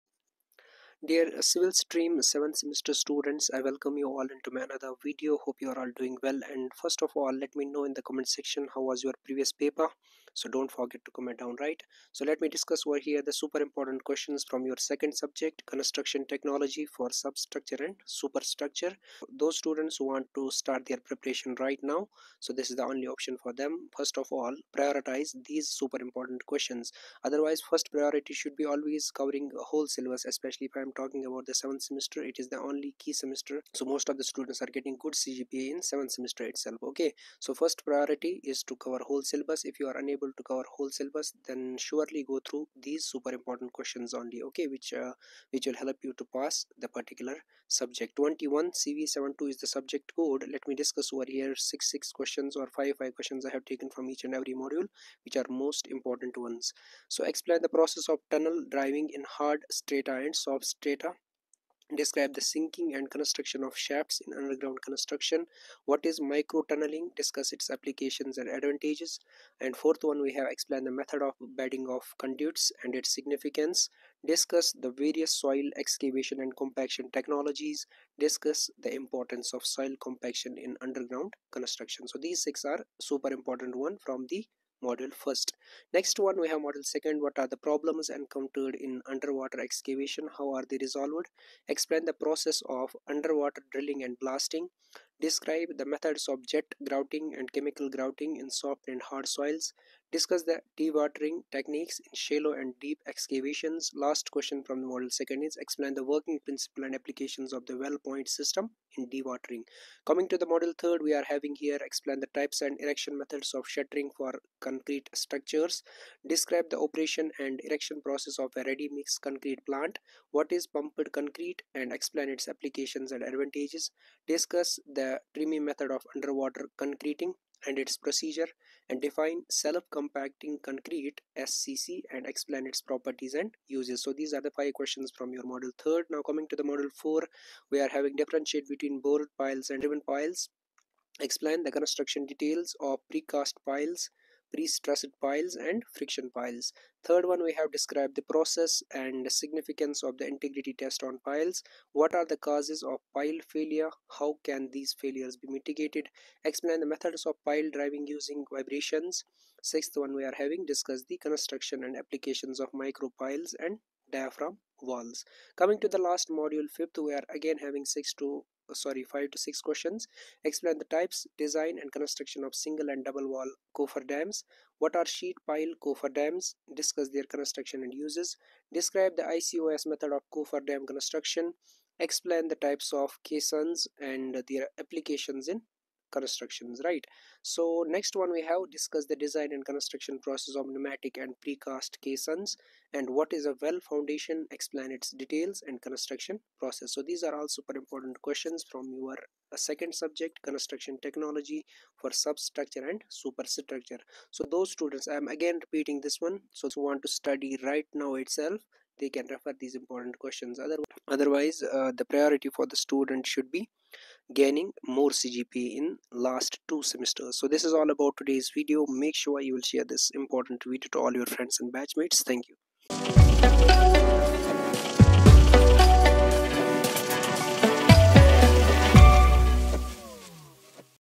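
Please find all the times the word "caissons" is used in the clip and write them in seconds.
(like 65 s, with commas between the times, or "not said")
183 s, 192 s.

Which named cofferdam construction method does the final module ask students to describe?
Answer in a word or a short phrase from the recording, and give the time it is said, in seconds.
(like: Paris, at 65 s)
ICOS method, at 179 s.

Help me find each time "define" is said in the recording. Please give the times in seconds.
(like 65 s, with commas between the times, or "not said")
129 s.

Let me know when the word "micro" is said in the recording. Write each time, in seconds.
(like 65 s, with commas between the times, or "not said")
66 s, 162 s.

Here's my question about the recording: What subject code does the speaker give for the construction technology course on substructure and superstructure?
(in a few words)
21CV72.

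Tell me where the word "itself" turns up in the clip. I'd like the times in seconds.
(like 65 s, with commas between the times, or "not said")
36 s, 208 s.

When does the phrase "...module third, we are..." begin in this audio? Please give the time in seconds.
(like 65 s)
110 s.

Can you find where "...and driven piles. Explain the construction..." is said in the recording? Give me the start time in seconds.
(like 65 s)
139 s.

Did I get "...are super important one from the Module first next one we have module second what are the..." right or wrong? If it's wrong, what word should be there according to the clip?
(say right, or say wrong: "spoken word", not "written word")
right.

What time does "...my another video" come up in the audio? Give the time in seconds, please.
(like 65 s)
4 s.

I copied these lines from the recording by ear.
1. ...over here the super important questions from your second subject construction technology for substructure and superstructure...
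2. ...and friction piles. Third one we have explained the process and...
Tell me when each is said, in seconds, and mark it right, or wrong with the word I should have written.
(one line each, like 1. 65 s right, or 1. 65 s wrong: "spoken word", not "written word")
1. 12 s right
2. 145 s wrong: "described", not "explained".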